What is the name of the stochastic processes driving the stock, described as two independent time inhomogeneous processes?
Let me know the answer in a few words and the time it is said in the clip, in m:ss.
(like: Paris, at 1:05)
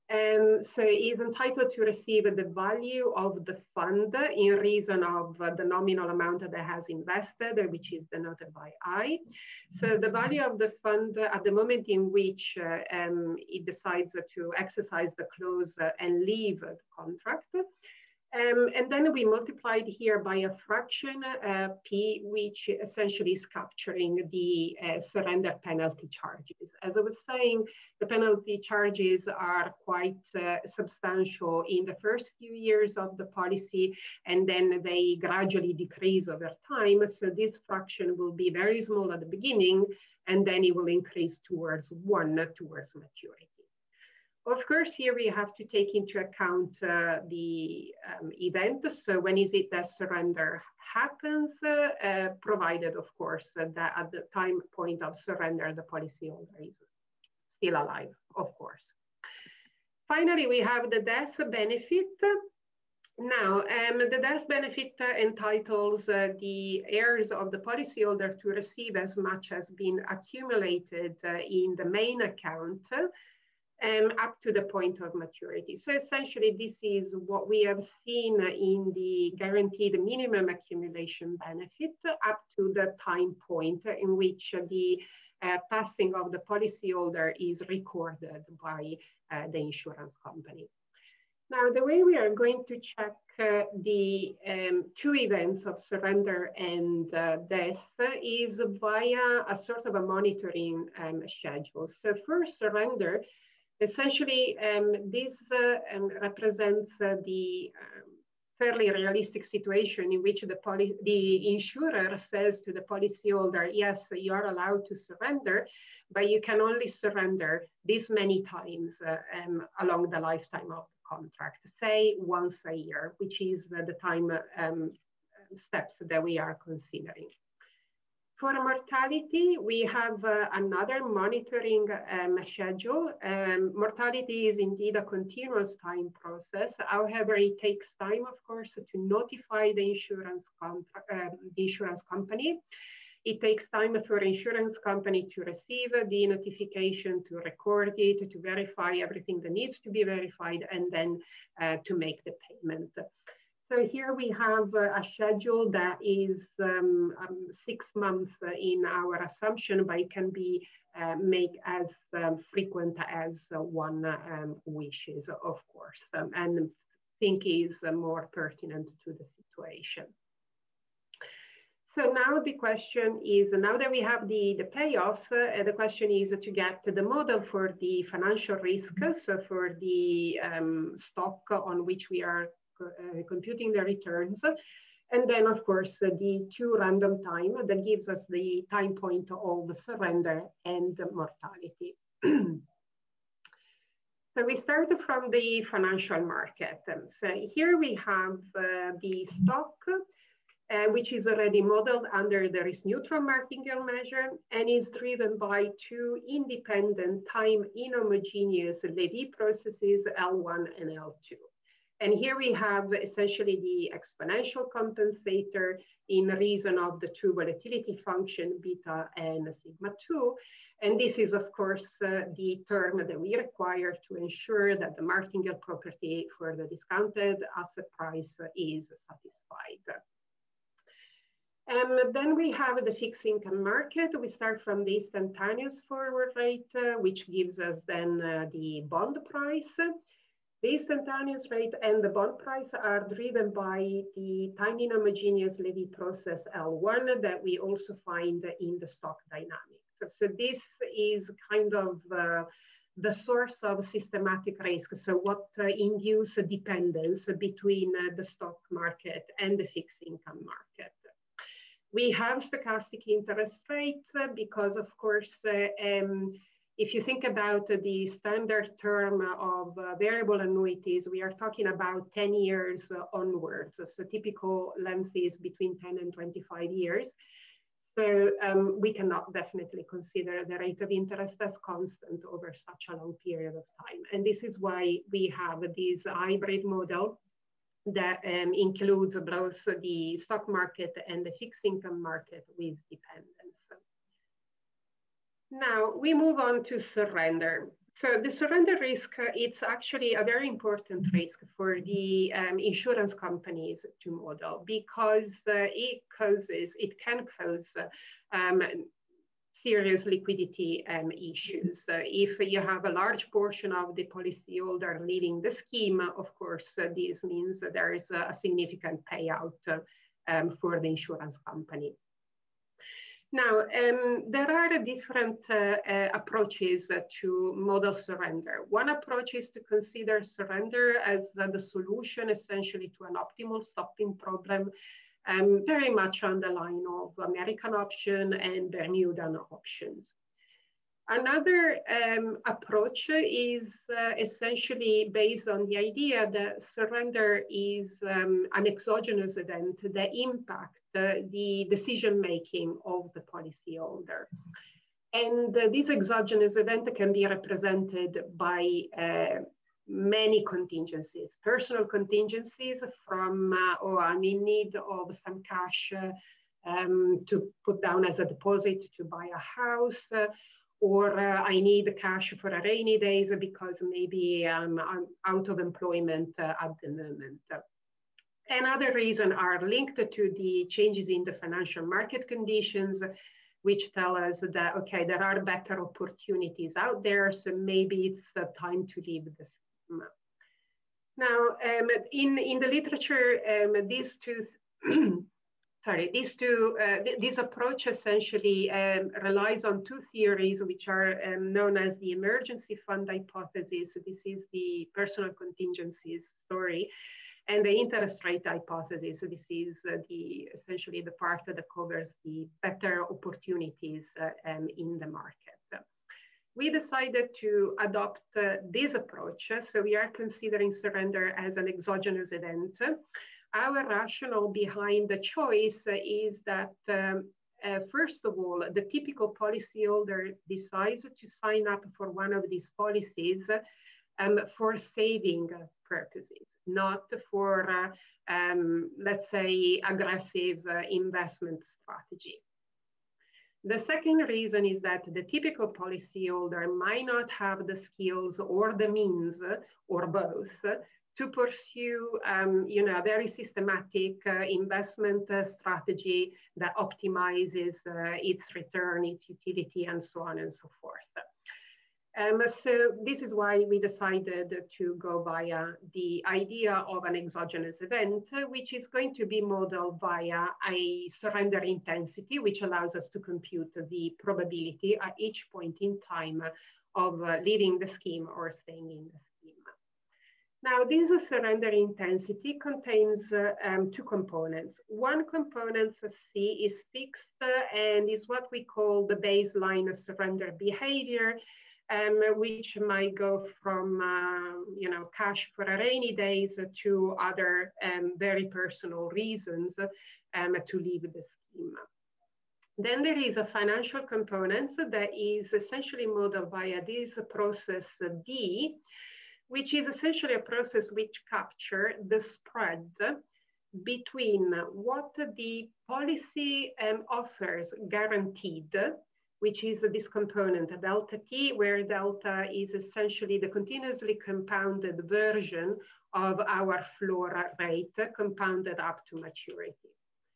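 Levy processes, at 3:28.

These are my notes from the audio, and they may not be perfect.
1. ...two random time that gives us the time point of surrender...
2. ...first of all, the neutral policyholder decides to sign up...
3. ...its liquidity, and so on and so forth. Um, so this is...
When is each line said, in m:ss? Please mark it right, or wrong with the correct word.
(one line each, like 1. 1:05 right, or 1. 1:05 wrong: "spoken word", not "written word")
1. 3:06 right
2. 7:07 wrong: "typical", not "neutral"
3. 7:39 wrong: "utility", not "liquidity".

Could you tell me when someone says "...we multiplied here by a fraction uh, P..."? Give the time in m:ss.
0:19.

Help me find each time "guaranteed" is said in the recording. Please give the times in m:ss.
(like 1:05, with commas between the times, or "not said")
1:19, 8:37.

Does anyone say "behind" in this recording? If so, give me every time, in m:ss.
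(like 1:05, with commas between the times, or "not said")
7:04.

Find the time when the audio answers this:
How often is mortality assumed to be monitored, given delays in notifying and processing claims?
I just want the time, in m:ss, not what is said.
2:37.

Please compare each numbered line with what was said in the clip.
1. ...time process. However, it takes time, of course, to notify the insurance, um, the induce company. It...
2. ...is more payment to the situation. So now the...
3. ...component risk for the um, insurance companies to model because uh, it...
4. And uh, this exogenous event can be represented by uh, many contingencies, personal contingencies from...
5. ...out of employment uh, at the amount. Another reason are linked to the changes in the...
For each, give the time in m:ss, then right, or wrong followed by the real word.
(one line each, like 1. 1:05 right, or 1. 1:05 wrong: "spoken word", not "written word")
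1. 2:15 wrong: "insurance", not "induce"
2. 2:47 wrong: "pertinent", not "payment"
3. 5:00 wrong: "important", not "component"
4. 5:55 right
5. 6:15 wrong: "moment", not "amount".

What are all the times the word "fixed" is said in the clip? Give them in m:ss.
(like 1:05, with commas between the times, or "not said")
3:52, 4:19, 4:51, 8:06.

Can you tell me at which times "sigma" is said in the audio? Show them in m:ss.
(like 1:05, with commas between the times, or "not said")
3:39.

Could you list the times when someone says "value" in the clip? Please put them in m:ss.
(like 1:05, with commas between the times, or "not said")
0:02, 0:10.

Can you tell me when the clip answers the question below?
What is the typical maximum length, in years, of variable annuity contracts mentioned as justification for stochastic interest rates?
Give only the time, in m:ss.
4:36.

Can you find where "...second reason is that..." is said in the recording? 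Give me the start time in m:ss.
7:23.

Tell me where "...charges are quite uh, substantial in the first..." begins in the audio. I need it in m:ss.
0:28.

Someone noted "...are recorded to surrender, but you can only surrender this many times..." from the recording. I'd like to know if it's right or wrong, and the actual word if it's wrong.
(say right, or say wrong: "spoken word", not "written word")
wrong: "allowed", not "recorded".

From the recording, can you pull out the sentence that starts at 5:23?
Now, um, there are different uh, uh, approaches to model surrender.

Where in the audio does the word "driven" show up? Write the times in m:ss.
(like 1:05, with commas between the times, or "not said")
3:24, 4:03.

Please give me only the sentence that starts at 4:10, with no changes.
So, so this is kind of uh, the source of systematic risk.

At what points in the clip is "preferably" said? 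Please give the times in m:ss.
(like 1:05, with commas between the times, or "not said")
not said.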